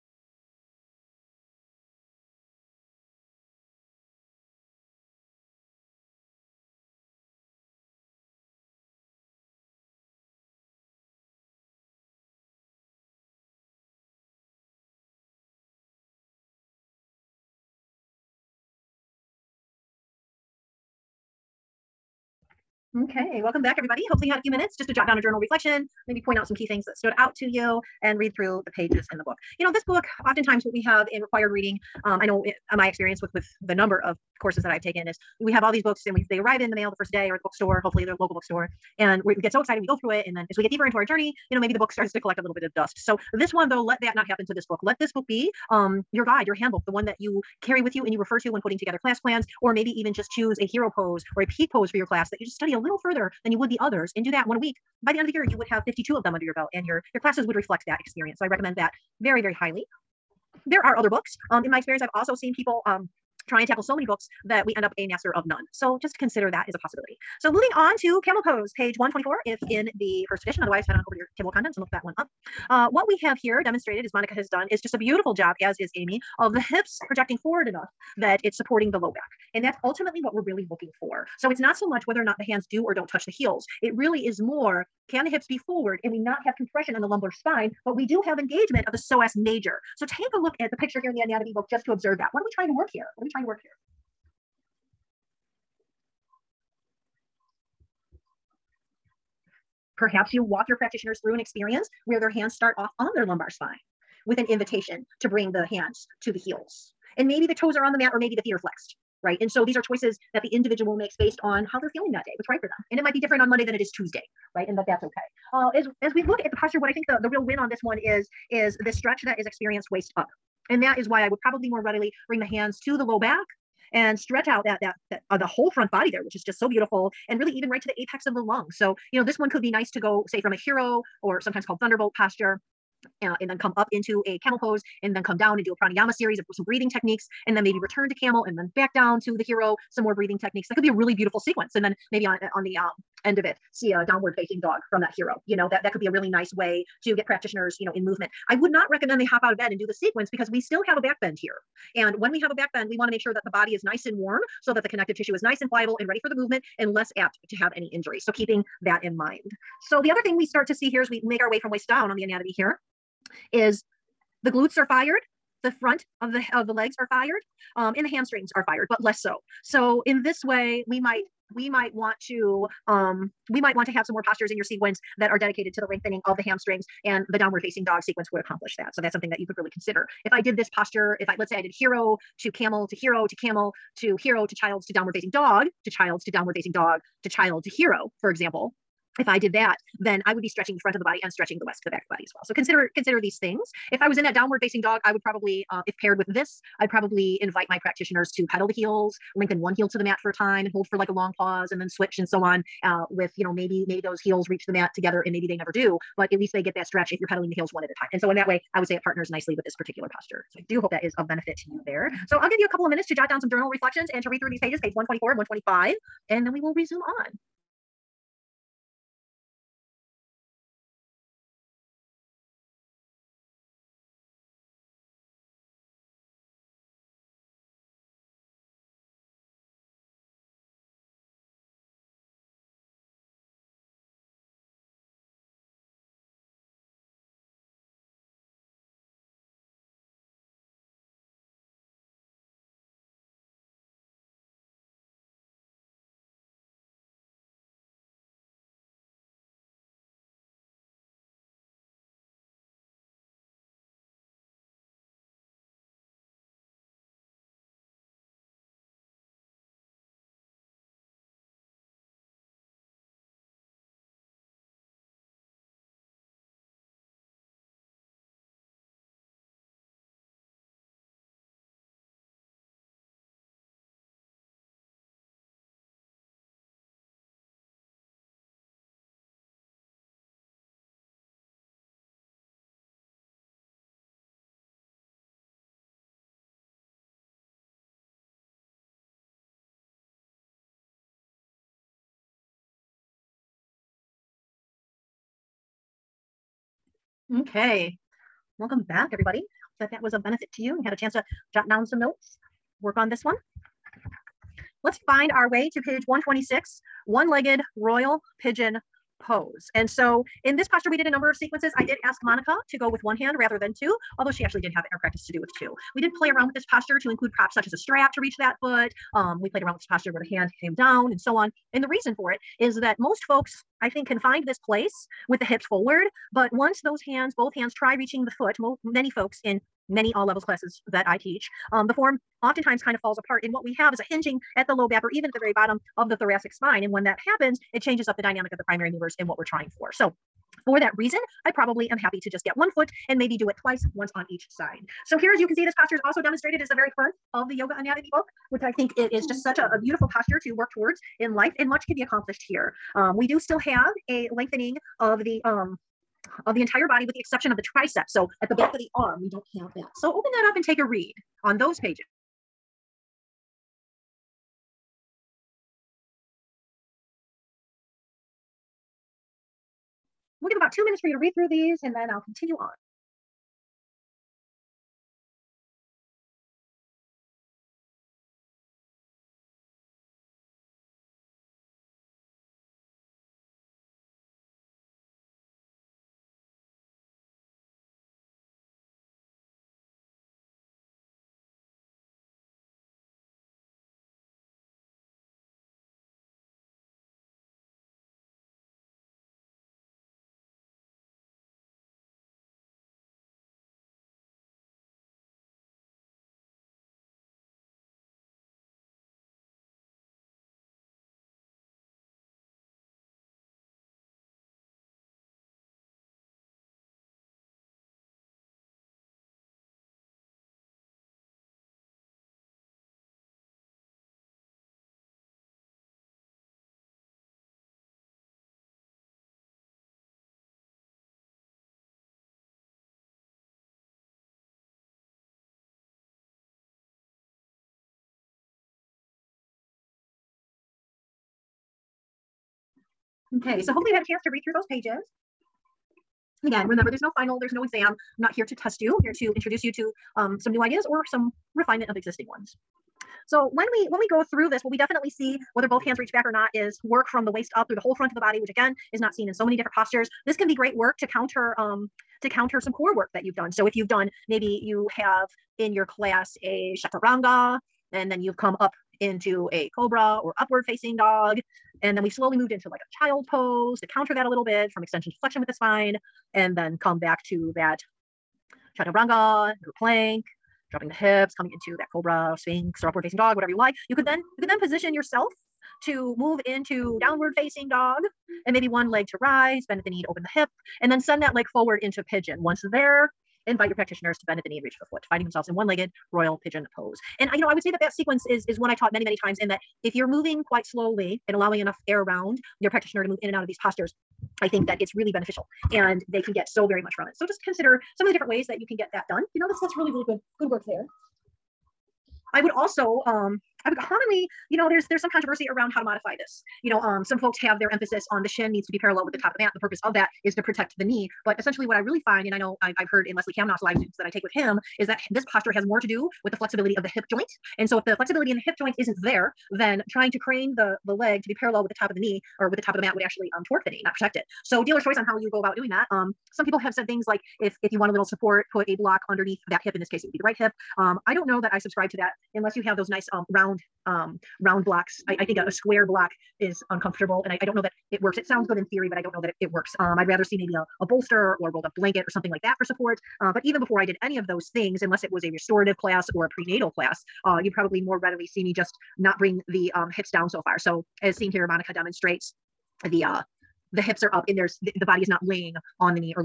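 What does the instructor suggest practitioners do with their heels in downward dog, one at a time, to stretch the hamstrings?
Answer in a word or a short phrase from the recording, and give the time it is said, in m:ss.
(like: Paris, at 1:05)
pedal the heels, at 3:18.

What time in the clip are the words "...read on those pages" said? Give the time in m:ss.
6:00.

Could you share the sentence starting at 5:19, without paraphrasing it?
Um, we played around with this posture where the hand came down and so on.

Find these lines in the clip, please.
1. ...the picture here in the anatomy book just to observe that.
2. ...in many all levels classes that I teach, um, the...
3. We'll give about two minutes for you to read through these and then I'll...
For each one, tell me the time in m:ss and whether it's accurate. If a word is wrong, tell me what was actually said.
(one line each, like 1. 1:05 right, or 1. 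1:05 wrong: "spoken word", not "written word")
1. 1:30 right
2. 5:29 right
3. 6:10 right.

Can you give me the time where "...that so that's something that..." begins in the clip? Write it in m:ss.
2:58.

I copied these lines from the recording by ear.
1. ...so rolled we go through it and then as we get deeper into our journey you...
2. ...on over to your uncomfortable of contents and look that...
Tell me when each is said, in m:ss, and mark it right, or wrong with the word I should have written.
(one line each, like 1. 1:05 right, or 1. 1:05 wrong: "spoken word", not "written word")
1. 0:39 wrong: "excited", not "rolled"
2. 1:10 wrong: "table", not "uncomfortable".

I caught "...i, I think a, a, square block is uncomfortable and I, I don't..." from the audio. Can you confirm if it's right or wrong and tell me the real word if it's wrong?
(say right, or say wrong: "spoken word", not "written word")
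right.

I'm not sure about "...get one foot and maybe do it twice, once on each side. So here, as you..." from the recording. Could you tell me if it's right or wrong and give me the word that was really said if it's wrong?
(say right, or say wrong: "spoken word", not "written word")
right.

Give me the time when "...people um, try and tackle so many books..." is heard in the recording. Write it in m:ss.
1:02.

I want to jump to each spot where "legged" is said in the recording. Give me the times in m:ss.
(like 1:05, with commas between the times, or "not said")
5:07, 8:15.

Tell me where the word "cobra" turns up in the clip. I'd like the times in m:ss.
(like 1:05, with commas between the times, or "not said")
7:49, 8:01.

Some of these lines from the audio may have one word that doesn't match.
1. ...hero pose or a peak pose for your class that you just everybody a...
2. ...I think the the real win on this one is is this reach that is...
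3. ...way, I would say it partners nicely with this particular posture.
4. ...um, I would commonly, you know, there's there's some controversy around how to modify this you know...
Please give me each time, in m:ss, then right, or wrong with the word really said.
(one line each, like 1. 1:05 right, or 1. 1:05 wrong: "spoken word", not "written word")
1. 0:50 wrong: "study", not "everybody"
2. 1:56 wrong: "stretch", not "reach"
3. 3:28 right
4. 8:33 right.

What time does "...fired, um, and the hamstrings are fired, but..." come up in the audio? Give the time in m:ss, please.
2:47.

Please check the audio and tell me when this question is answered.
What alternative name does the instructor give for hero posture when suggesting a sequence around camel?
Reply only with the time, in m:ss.
2:11.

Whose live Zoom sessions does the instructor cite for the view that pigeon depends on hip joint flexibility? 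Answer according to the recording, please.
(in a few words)
Leslie Kaminoff.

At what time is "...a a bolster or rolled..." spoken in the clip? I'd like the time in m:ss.
9:10.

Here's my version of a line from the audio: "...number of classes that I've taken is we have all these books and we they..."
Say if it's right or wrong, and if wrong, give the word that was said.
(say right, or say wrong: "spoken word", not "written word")
wrong: "courses", not "classes".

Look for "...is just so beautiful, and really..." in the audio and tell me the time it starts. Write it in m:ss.
2:06.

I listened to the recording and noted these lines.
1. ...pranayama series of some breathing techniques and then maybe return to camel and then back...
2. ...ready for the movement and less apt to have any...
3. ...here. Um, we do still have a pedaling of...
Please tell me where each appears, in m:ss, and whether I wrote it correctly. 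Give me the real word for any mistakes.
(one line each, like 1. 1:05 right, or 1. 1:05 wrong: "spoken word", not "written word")
1. 2:15 right
2. 2:36 right
3. 5:52 wrong: "lengthening", not "pedaling".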